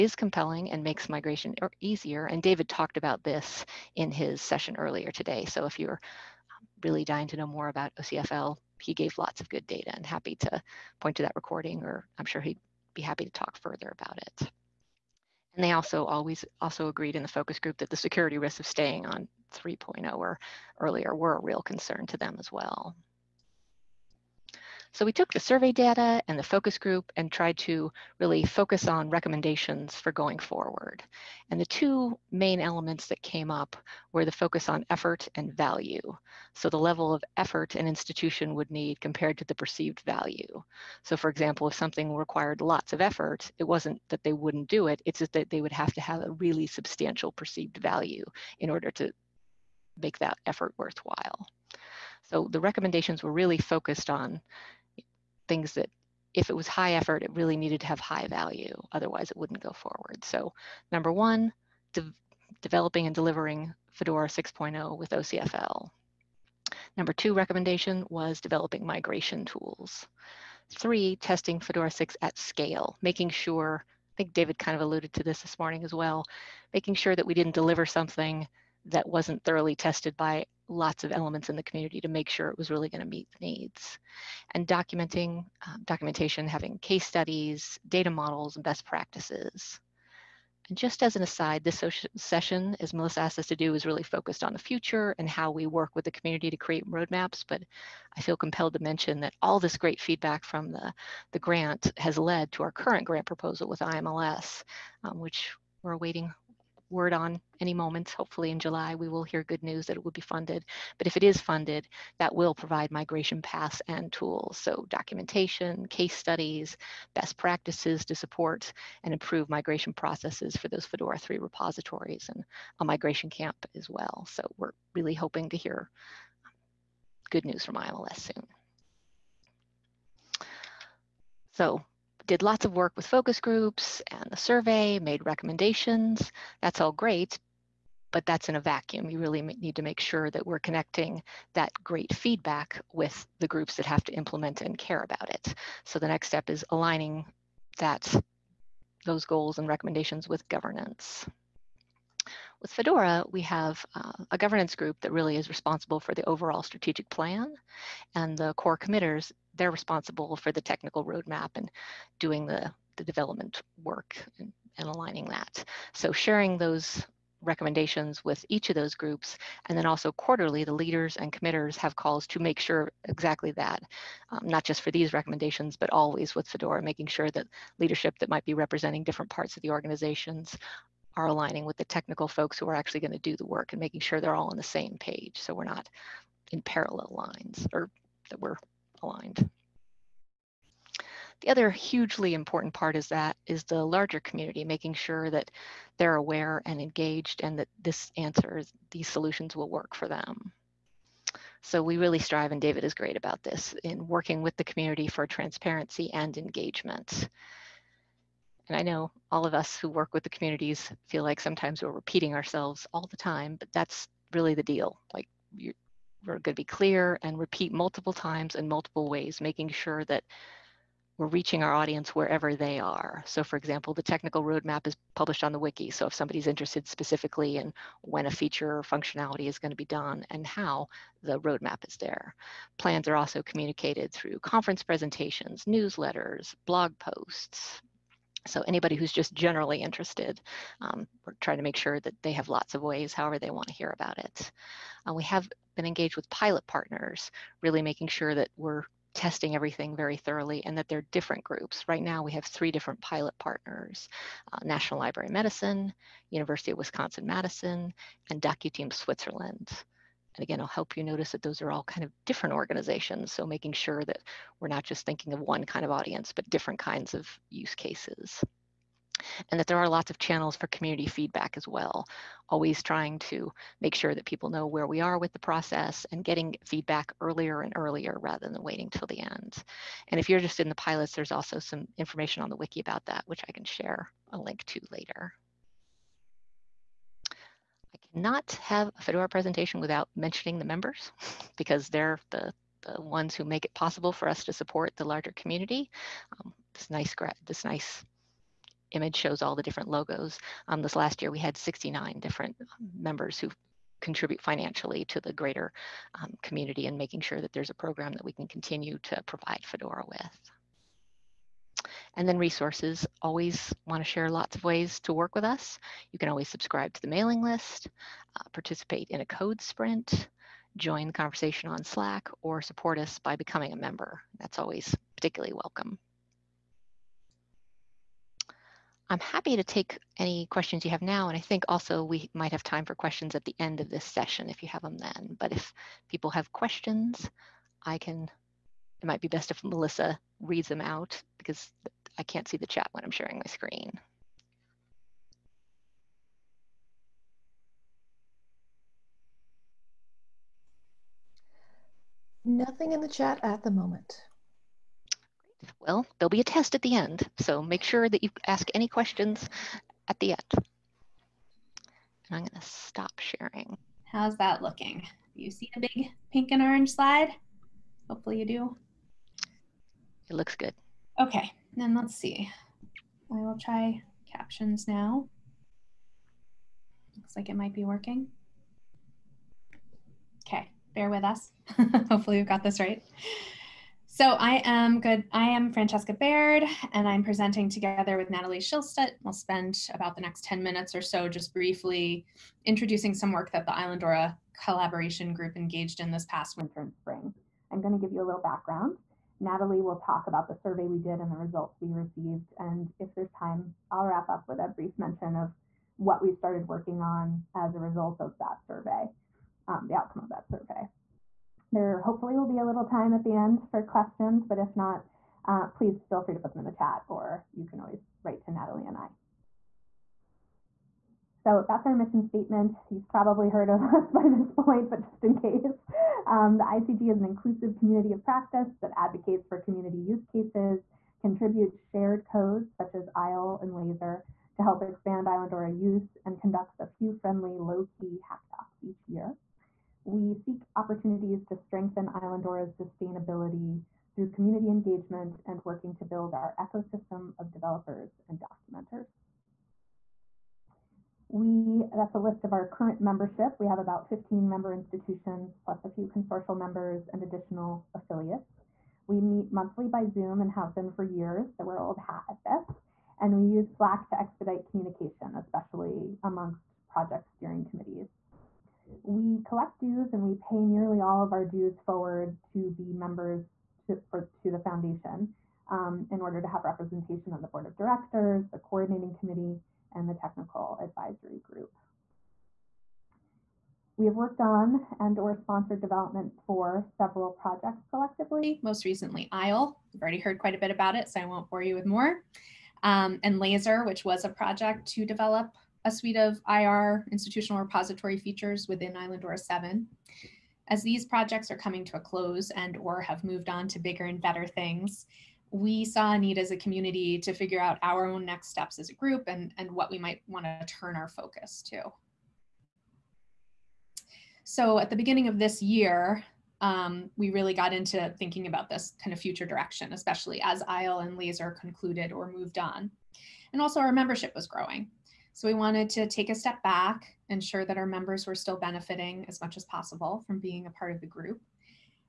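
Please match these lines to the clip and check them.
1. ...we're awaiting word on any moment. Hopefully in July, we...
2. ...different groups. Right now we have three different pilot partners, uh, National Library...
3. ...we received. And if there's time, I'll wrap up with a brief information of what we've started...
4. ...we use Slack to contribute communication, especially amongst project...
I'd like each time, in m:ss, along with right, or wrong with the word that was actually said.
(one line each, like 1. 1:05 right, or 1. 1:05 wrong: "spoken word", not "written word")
1. 1:45 right
2. 4:11 right
3. 6:41 wrong: "mention", not "information"
4. 7:43 wrong: "expedite", not "contribute".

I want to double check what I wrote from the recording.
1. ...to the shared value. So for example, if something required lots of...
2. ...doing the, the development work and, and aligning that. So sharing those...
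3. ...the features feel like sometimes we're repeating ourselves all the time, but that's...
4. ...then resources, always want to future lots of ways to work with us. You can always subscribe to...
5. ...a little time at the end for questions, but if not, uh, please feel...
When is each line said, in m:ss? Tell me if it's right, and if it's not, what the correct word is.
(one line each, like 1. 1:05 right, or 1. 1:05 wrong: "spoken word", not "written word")
1. 0:39 wrong: "perceived", not "shared"
2. 2:42 right
3. 3:30 wrong: "communities", not "features"
4. 5:12 wrong: "share", not "future"
5. 6:52 right.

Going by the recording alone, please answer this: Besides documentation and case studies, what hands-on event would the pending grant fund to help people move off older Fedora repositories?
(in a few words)
migration camp.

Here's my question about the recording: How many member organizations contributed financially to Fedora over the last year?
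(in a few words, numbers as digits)
69.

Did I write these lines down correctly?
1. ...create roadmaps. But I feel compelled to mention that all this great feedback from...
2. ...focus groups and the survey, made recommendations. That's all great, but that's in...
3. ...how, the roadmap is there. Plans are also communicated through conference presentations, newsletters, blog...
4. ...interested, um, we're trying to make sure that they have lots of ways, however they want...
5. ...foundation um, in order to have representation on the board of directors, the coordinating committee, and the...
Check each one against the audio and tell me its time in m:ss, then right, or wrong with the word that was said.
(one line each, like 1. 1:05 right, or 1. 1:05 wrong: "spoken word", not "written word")
1. 1:36 right
2. 2:13 right
3. 3:50 right
4. 3:59 right
5. 7:54 right.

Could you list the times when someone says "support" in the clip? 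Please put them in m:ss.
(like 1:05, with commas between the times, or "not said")
1:58, 4:54, 5:22.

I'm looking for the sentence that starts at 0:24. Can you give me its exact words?
So we took the survey data and the focus group and tried to really focus on recommendations for going forward.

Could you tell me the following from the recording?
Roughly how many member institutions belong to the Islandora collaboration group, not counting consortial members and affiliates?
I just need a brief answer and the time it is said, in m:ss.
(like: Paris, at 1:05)
15, at 7:34.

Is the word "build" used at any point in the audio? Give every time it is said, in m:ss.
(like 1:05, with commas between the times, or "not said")
7:26.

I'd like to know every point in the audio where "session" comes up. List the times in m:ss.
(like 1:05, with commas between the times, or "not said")
0:04, 1:32, 5:34.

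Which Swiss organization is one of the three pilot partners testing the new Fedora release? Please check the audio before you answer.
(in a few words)
DocuTeam Switzerland.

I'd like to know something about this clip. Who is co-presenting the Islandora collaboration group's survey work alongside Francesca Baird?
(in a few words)
Natalie Schilstedt.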